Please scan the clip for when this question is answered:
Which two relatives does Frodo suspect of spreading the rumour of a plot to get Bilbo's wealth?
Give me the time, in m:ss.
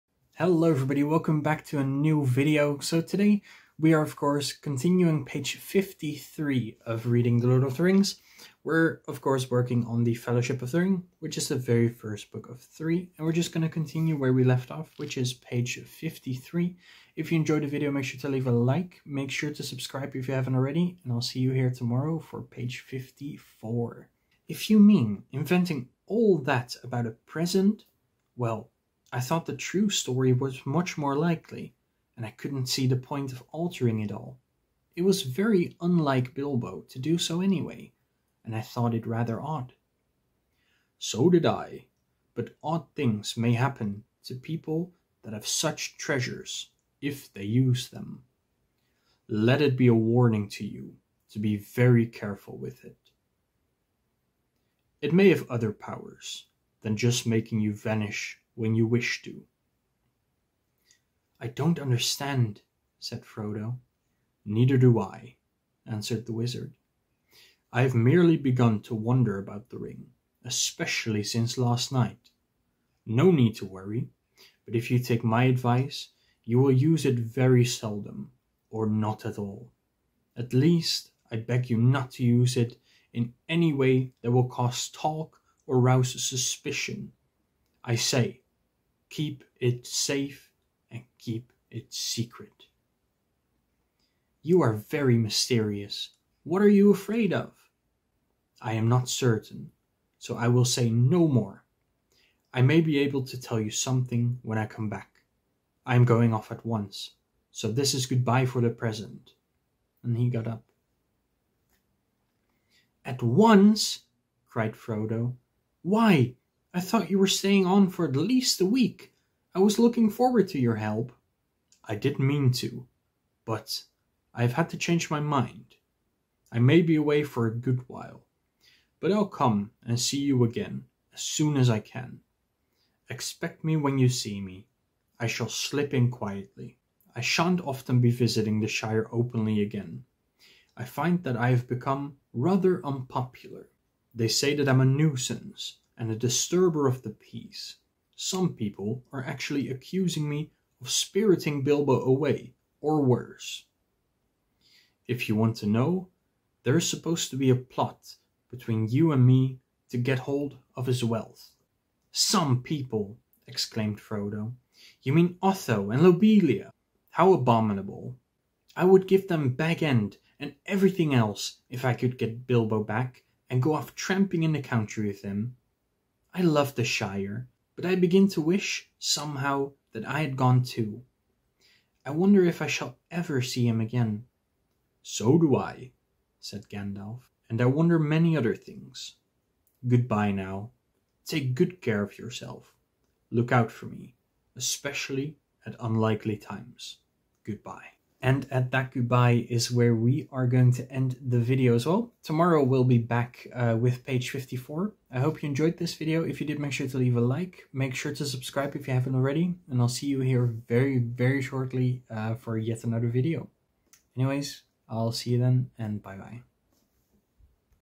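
2:45.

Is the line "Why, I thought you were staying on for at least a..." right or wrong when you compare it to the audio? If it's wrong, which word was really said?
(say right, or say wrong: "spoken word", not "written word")
right.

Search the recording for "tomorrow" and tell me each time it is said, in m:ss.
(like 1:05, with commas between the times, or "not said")
0:21, 3:22.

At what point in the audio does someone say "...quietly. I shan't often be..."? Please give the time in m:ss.
2:16.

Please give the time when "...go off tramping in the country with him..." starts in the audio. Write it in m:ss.
2:53.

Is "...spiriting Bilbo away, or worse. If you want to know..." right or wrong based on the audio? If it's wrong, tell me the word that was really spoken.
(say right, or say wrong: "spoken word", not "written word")
right.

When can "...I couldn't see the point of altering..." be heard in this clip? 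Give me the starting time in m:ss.
0:32.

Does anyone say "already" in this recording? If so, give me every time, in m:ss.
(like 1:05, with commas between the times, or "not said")
0:20, 3:29.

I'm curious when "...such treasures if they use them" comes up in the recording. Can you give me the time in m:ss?
0:45.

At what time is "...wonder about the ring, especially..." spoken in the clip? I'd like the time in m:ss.
1:08.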